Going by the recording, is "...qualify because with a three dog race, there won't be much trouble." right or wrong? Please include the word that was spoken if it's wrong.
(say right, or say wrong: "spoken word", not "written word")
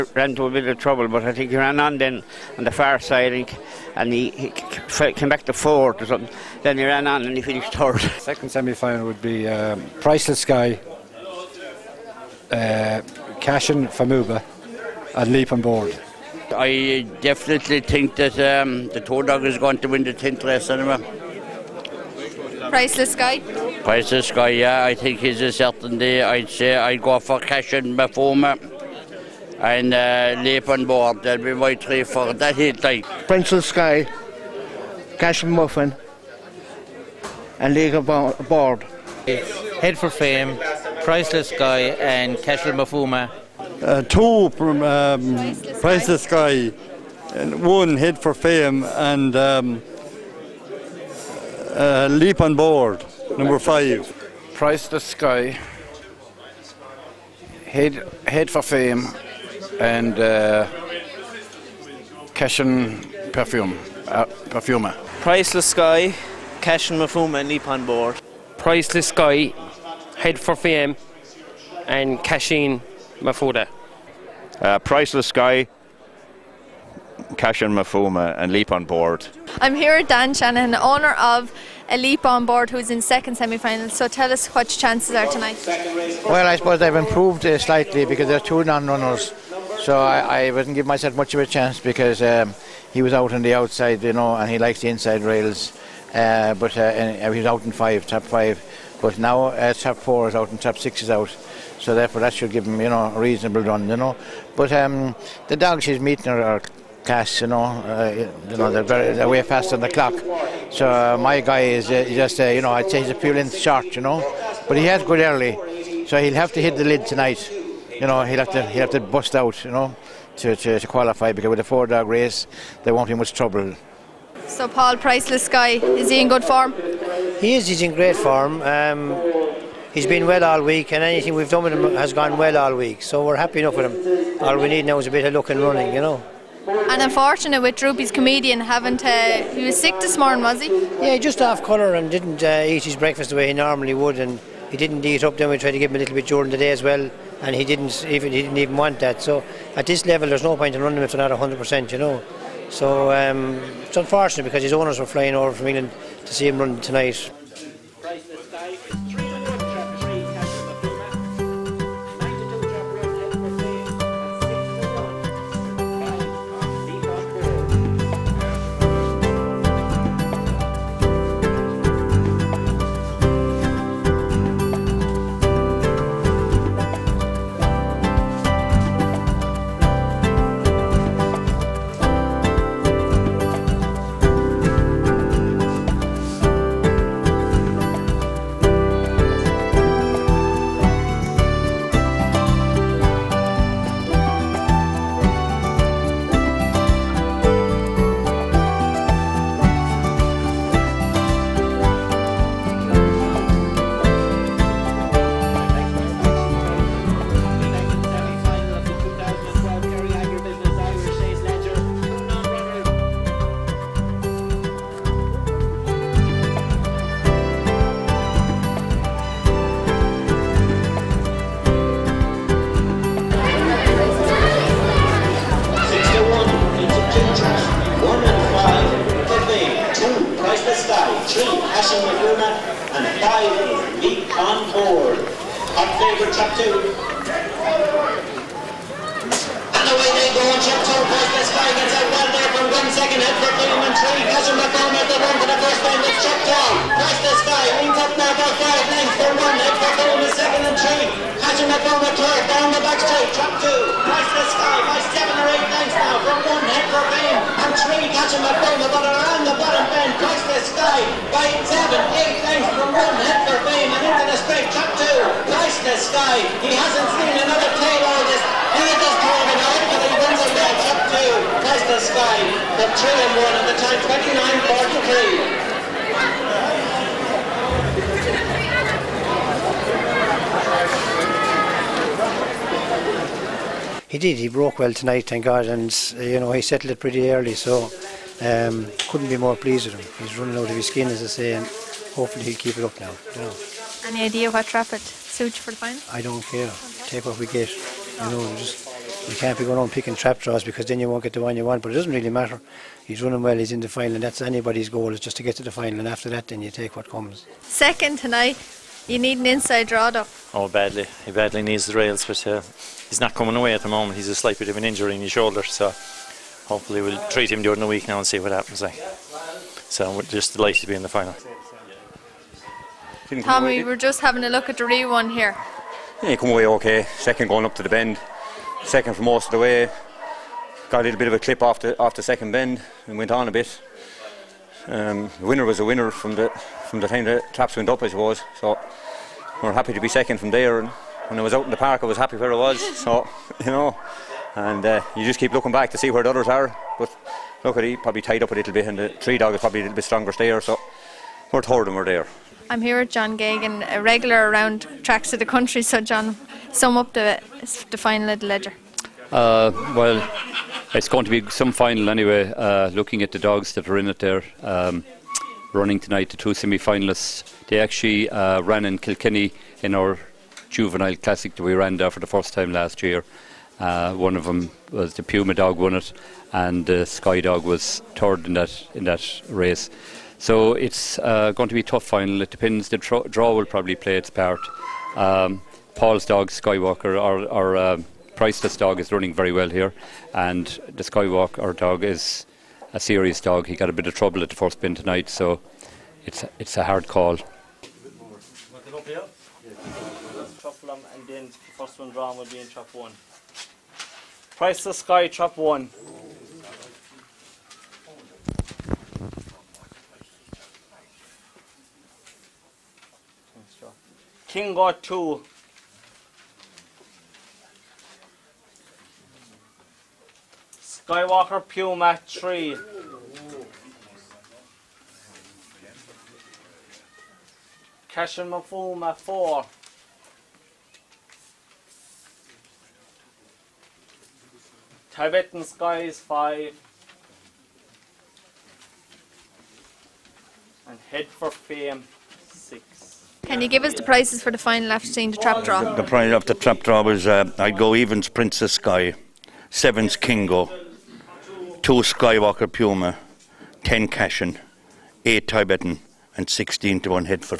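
wrong: "four", not "three".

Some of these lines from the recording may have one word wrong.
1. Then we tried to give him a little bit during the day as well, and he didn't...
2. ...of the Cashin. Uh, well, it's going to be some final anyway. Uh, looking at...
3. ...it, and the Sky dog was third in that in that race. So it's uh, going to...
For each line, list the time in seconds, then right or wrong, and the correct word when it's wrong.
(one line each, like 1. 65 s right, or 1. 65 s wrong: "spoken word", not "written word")
1. 145 s right
2. 358 s wrong: "Leger", not "Cashin"
3. 375 s right.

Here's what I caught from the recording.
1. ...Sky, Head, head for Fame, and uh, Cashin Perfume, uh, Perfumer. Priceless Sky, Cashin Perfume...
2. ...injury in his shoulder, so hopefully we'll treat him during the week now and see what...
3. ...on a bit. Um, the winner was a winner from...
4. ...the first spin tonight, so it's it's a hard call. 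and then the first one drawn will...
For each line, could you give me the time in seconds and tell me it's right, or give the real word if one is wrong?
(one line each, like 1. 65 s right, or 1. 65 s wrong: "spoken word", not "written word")
1. 55 s right
2. 314 s right
3. 333 s right
4. 394 s right.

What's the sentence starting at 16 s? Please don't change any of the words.
I definitely think that um, the tow Dog is going to win the 10th race anyway.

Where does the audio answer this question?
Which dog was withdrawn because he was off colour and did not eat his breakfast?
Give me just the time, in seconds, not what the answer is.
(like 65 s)
137 s.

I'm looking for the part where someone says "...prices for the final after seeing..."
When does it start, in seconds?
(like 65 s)
444 s.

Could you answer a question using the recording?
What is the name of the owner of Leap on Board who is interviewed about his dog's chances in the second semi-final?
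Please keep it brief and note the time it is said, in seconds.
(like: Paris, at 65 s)
Dan Shannon, at 80 s.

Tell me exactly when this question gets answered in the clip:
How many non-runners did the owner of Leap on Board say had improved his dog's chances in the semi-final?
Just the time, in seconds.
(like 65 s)
88 s.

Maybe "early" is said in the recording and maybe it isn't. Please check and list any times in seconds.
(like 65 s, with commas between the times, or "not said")
115 s, 287 s.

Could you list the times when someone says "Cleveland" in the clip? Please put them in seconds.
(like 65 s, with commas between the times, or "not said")
249 s, 257 s.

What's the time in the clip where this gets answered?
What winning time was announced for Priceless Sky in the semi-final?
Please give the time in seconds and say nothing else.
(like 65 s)
275 s.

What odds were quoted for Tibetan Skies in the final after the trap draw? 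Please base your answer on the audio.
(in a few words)
8.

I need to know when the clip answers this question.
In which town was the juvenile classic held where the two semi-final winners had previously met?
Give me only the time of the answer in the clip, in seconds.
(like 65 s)
368 s.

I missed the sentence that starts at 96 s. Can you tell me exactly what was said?
Uh, but uh, uh he was out in five, top five.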